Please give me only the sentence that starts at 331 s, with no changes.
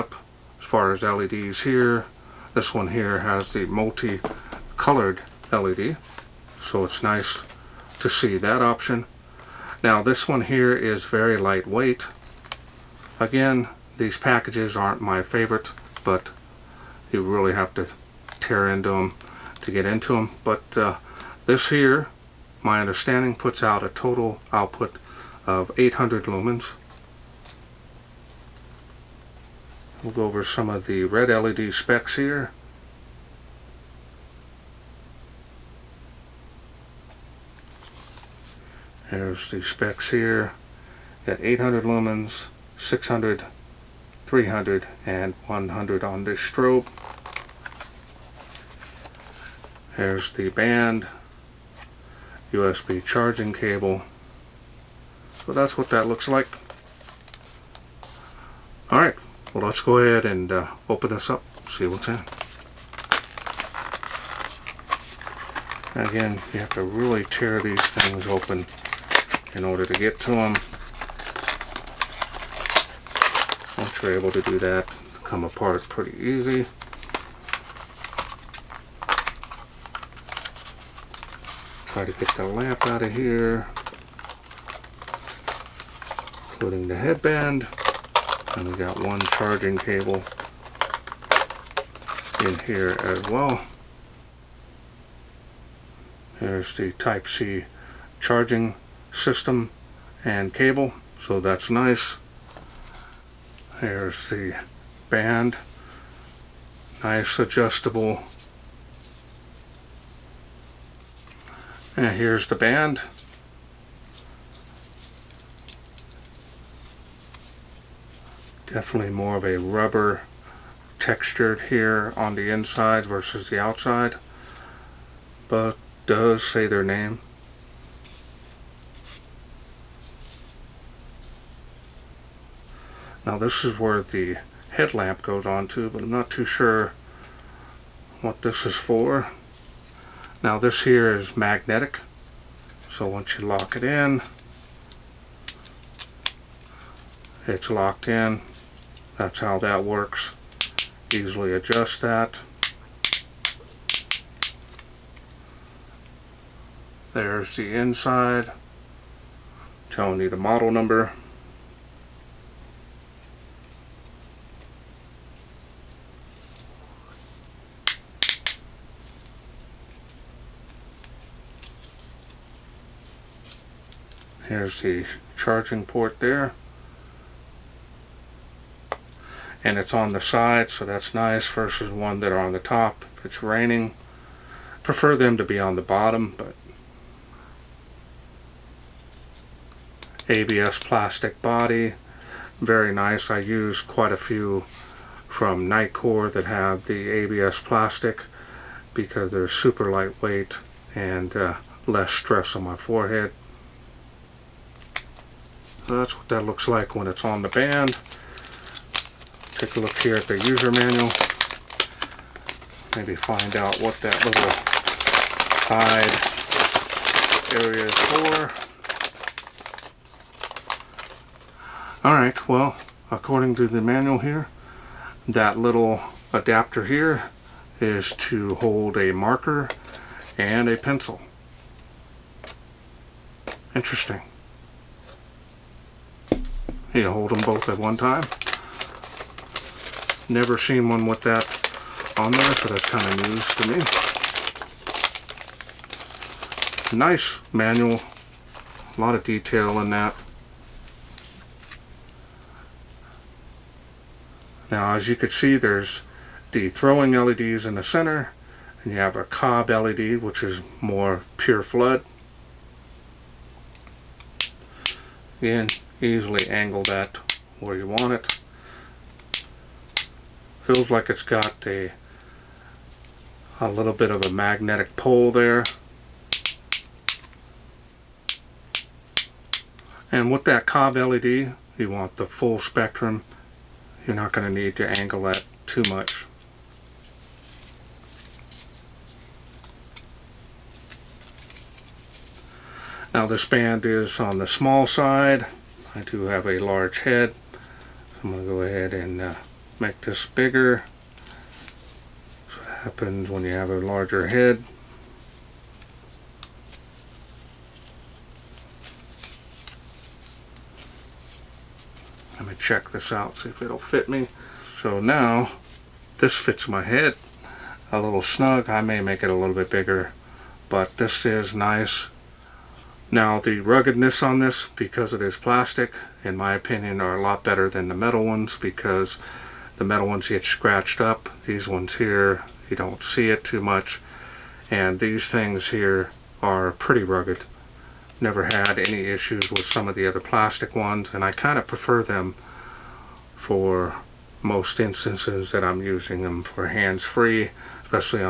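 These ones here, you don't see it too much.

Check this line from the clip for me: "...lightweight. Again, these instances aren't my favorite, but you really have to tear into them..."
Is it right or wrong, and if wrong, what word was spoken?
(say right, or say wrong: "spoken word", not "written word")
wrong: "packages", not "instances".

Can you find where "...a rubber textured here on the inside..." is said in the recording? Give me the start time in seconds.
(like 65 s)
119 s.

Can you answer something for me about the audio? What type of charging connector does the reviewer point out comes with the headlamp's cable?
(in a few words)
Type C.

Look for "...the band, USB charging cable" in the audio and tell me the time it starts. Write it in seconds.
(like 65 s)
50 s.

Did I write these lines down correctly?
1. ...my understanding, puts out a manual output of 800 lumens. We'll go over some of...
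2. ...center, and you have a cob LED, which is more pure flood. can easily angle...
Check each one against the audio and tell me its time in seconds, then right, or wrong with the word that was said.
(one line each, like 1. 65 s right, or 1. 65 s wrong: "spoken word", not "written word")
1. 22 s wrong: "total", not "manual"
2. 257 s right.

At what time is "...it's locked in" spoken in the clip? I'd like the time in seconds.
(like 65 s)
147 s.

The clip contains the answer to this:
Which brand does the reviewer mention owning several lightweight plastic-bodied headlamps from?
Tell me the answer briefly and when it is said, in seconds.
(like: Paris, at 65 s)
Nitecore, at 195 s.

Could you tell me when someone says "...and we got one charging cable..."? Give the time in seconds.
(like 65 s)
88 s.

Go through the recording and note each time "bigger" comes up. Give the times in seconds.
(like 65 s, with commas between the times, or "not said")
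300 s, 319 s.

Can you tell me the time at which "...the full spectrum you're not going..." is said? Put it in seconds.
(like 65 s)
282 s.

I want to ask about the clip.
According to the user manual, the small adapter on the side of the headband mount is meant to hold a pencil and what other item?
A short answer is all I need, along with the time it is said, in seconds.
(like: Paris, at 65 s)
A marker, at 228 s.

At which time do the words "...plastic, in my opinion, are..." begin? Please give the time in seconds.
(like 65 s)
325 s.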